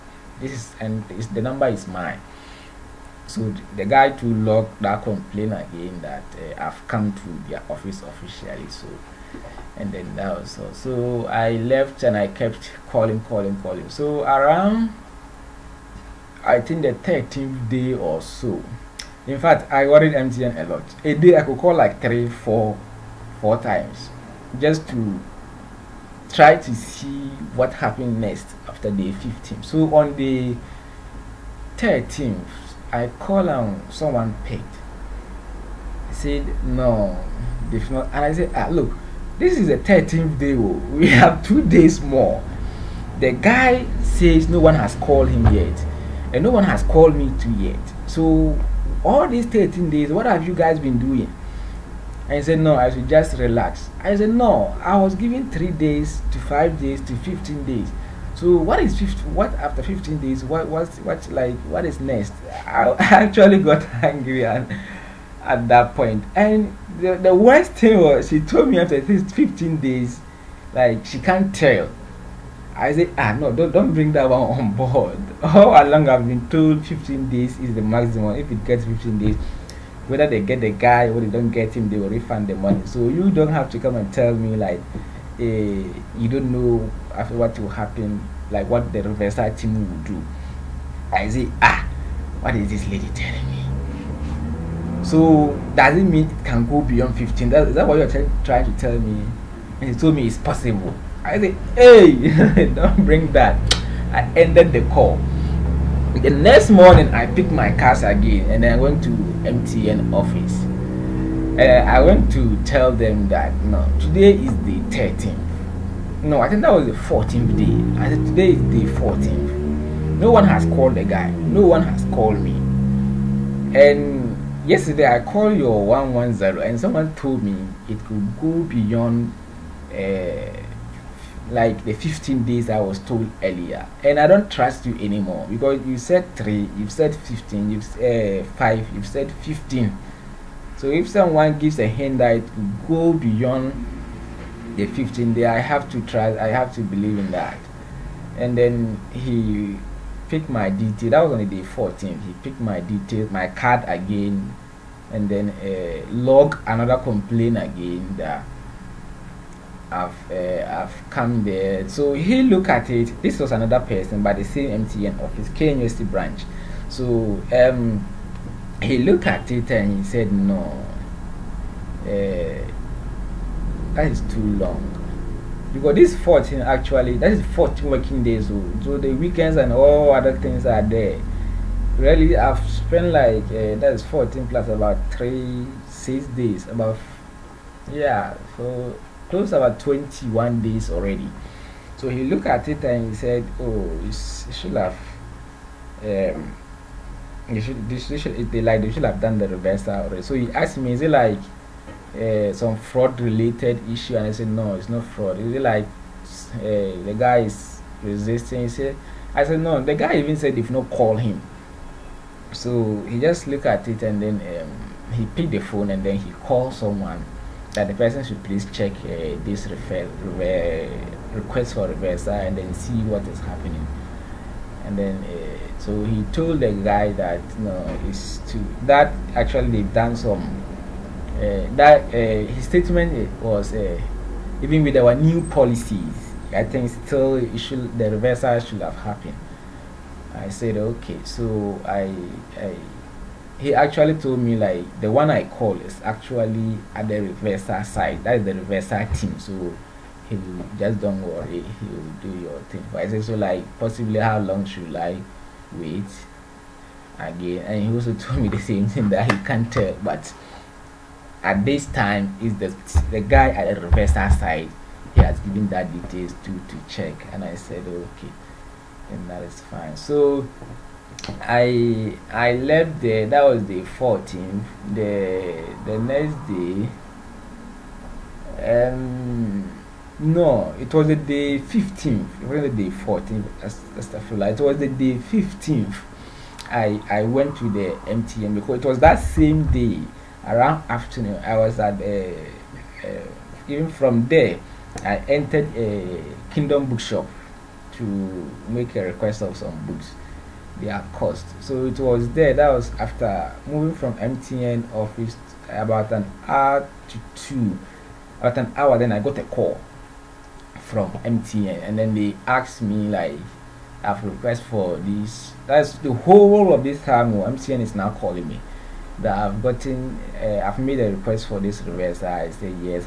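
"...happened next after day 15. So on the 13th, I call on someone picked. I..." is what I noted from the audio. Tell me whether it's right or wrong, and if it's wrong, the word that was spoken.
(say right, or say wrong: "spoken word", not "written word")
right.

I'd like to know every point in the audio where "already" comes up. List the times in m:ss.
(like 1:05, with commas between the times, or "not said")
3:10, 3:19.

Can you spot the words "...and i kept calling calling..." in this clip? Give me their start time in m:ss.
0:12.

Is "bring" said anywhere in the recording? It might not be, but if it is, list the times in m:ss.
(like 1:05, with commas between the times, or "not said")
1:13, 1:43.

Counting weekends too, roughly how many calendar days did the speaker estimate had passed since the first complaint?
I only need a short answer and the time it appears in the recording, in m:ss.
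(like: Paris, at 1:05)
21 days, at 3:09.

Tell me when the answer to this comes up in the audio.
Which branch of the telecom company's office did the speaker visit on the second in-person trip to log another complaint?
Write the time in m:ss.
2:45.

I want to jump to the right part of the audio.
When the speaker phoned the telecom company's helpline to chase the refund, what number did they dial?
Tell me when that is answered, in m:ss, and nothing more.
2:05.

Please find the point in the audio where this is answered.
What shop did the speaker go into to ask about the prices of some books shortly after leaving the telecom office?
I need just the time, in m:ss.
4:56.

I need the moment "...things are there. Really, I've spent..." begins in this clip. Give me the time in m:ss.
3:00.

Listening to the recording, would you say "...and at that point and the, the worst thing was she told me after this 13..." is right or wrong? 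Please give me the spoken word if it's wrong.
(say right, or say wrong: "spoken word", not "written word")
wrong: "15", not "13".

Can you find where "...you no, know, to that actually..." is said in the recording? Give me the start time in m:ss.
3:47.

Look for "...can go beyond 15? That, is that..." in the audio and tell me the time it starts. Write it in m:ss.
1:36.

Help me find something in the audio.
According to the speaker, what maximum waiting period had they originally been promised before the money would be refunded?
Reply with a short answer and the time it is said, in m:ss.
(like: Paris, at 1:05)
15 days, at 1:16.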